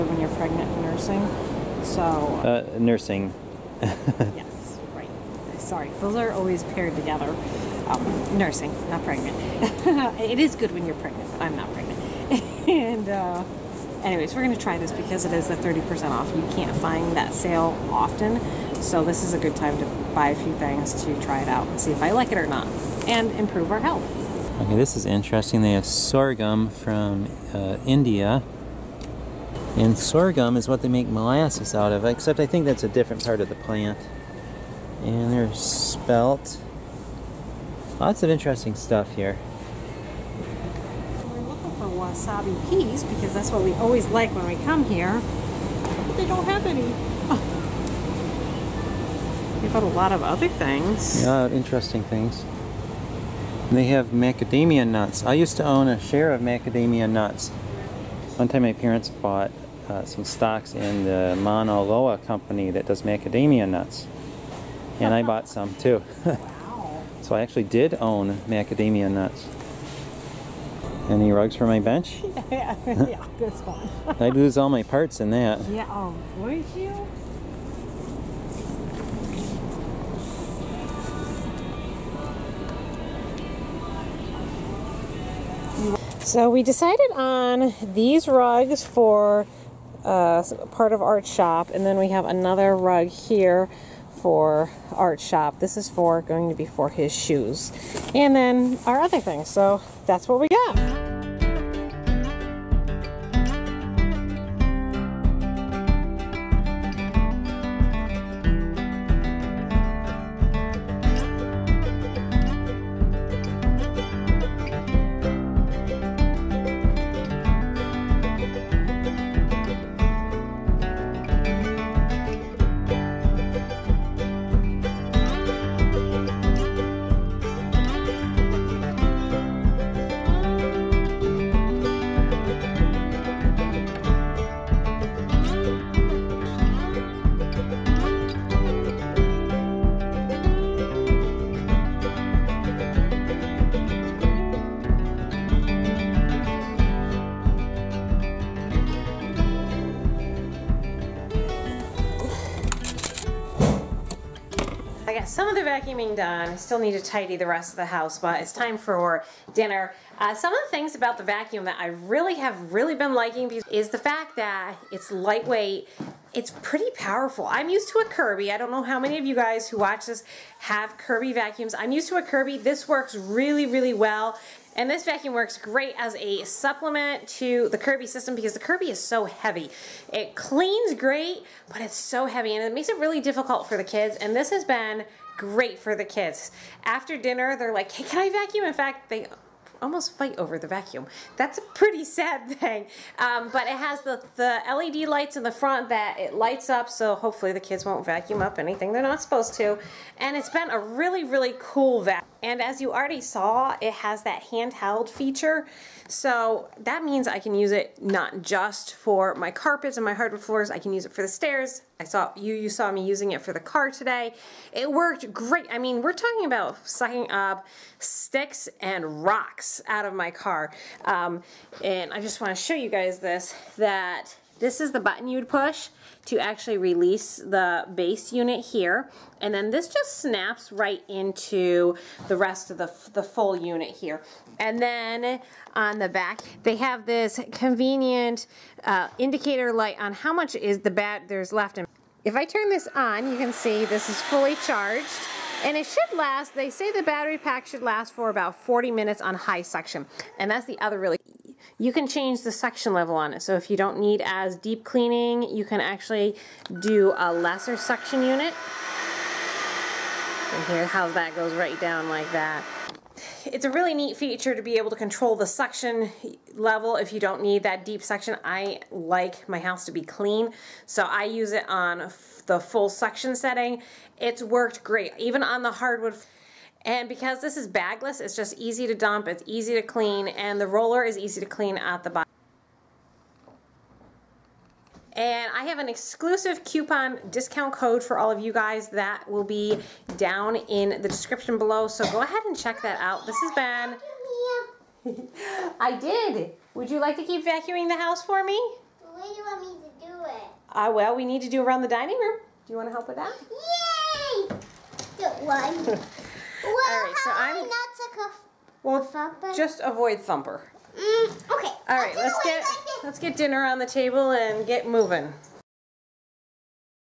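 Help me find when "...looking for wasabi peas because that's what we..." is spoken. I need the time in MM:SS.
00:41.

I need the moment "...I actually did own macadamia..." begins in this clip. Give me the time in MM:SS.
01:07.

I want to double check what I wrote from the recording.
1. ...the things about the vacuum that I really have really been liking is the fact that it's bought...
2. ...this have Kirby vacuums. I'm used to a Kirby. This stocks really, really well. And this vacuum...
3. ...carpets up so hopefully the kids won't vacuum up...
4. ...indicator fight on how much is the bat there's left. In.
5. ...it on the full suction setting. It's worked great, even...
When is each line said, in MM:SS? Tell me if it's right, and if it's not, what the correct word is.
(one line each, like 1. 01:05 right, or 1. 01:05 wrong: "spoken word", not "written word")
1. 02:40 wrong: "lightweight", not "bought"
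2. 02:50 wrong: "works", not "stocks"
3. 03:16 wrong: "lights", not "carpets"
4. 03:59 wrong: "light", not "fight"
5. 04:31 right.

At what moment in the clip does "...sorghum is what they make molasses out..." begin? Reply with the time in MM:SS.
00:29.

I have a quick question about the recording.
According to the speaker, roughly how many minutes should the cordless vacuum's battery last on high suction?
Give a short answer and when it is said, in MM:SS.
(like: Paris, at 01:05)
40 minutes, at 04:08.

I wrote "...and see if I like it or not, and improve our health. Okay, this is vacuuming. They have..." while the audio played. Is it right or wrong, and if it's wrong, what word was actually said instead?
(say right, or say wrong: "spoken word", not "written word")
wrong: "interesting", not "vacuuming".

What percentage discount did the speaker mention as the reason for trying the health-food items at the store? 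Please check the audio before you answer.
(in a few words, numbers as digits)
30%.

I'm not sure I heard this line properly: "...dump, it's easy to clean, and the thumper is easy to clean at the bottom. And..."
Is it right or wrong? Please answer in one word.
wrong.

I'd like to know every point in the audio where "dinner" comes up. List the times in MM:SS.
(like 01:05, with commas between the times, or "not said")
02:39, 03:07, 05:13.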